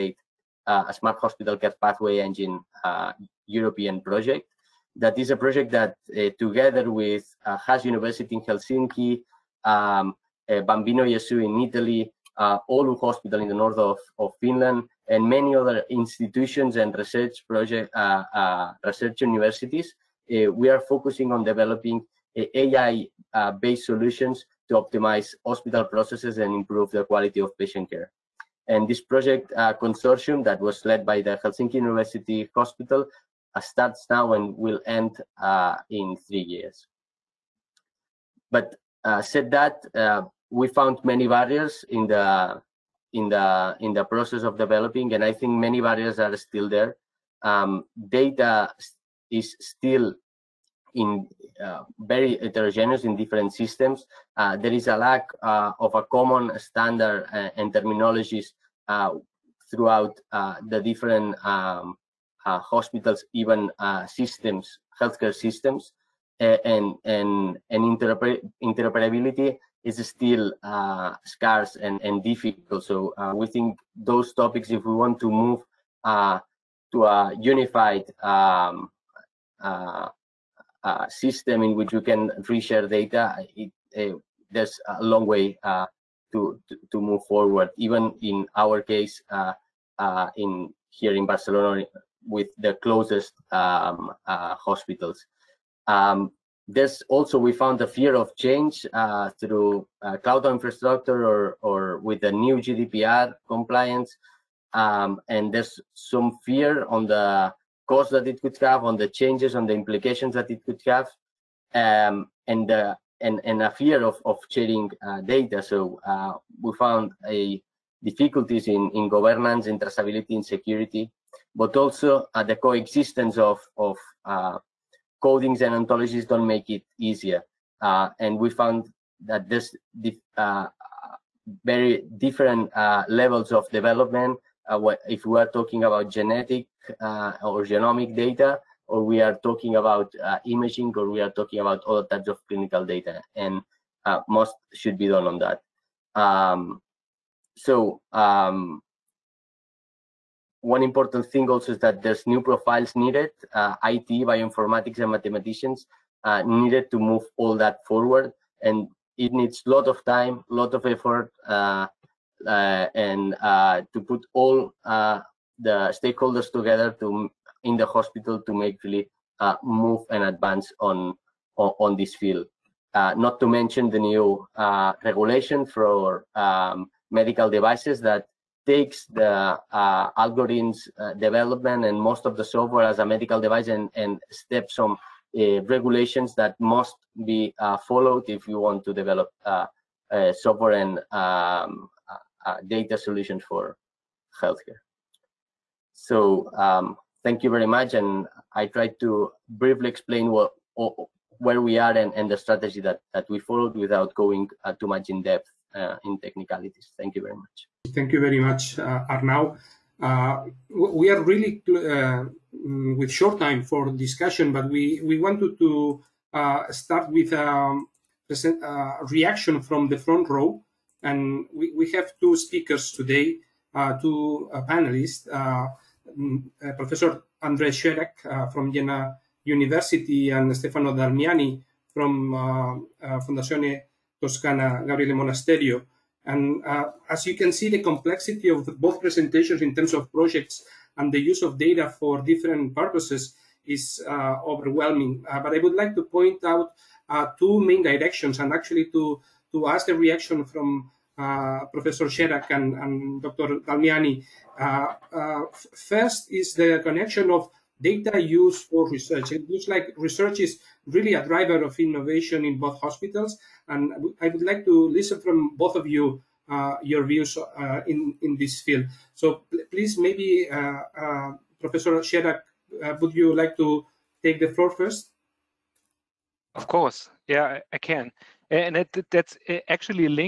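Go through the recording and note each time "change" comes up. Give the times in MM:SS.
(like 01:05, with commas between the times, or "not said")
01:38, 01:49.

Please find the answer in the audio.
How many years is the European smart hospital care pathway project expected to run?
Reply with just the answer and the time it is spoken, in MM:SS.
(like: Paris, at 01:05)
3, at 00:36.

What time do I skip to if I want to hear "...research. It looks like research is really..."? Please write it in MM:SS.
04:18.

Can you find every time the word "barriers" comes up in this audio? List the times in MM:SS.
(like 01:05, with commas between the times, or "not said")
00:41, 00:45.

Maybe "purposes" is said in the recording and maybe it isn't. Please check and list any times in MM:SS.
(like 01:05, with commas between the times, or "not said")
04:02.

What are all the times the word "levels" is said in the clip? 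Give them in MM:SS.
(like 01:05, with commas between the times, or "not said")
02:13.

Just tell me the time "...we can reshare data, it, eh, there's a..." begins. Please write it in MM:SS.
01:21.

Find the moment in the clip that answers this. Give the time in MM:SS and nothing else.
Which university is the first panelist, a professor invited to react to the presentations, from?
03:48.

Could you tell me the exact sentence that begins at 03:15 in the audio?
So um, thank you very much.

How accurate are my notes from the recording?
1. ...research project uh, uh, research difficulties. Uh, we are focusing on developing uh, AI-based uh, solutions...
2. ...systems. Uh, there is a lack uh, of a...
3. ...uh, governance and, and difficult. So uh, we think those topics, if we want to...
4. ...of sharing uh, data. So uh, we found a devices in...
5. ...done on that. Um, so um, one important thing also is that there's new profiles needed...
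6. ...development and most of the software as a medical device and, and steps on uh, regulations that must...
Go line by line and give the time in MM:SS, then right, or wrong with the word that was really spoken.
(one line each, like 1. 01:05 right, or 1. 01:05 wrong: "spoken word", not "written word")
1. 00:16 wrong: "universities", not "difficulties"
2. 00:53 right
3. 01:10 wrong: "scarce", not "governance"
4. 01:54 wrong: "difficulties", not "devices"
5. 02:25 right
6. 03:01 right.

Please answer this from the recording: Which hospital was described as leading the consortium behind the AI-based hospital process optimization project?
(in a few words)
Helsinki University Hospital.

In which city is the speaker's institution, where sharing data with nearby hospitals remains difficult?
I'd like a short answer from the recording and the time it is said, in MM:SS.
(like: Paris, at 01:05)
Barcelona, at 01:31.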